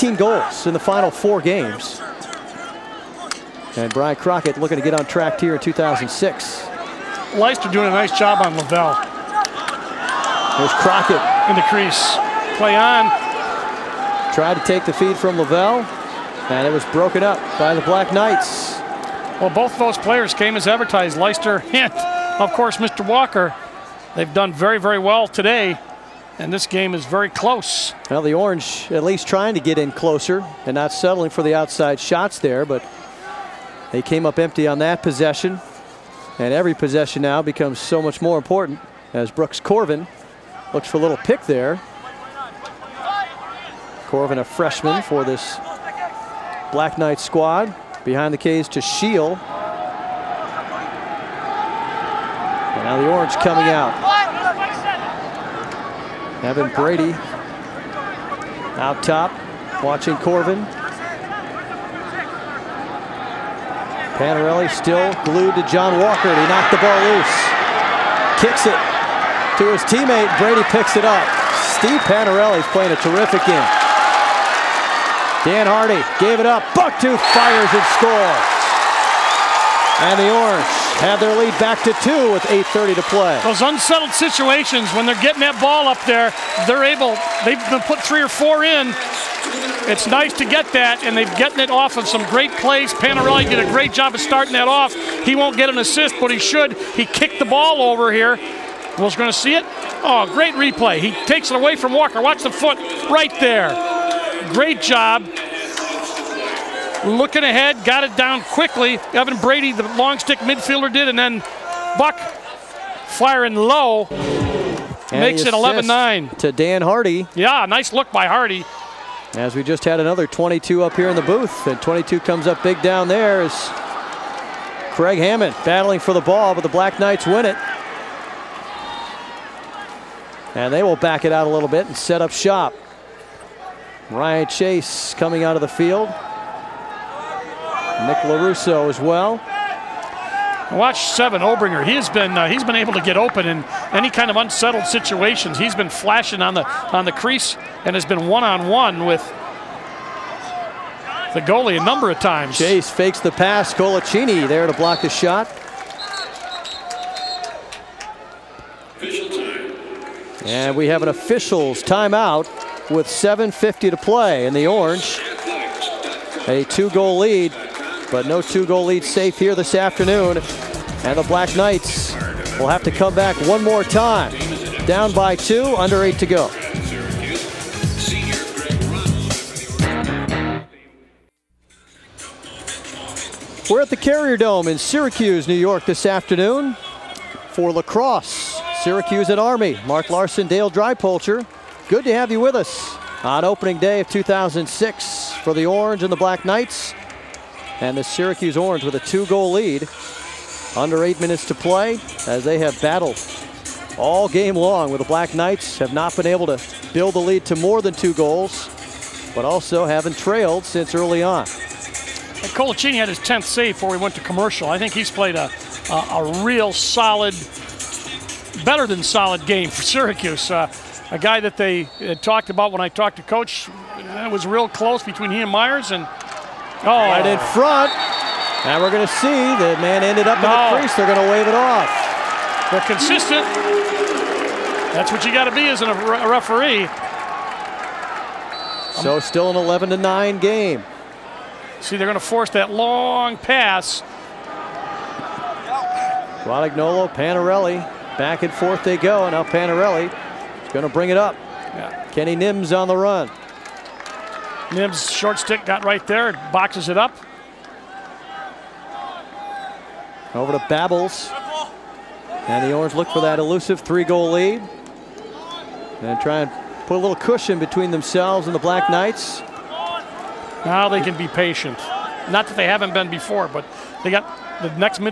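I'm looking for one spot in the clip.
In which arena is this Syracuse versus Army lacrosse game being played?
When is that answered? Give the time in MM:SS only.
03:03.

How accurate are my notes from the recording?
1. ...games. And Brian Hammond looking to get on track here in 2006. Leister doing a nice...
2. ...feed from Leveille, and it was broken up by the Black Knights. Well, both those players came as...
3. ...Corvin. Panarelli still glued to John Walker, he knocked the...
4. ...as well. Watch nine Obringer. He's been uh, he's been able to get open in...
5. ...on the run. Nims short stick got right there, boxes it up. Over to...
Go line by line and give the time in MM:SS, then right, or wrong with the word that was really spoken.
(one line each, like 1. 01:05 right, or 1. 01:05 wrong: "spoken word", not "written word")
1. 00:01 wrong: "Crockett", not "Hammond"
2. 00:14 right
3. 01:00 right
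4. 02:18 wrong: "seven", not "nine"
5. 04:12 right.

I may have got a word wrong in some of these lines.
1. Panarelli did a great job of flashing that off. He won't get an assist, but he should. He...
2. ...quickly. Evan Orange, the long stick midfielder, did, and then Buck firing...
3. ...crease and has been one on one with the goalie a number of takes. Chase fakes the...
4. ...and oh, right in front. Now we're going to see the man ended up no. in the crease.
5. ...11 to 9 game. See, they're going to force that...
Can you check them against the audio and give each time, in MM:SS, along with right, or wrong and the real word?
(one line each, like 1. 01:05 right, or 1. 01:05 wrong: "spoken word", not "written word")
1. 01:32 wrong: "starting", not "flashing"
2. 01:48 wrong: "Brady", not "Orange"
3. 02:27 wrong: "times", not "takes"
4. 03:45 right
5. 03:59 right.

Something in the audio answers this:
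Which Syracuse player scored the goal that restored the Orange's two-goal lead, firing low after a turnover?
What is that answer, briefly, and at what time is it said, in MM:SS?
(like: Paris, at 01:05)
Bucktooth, at 01:16.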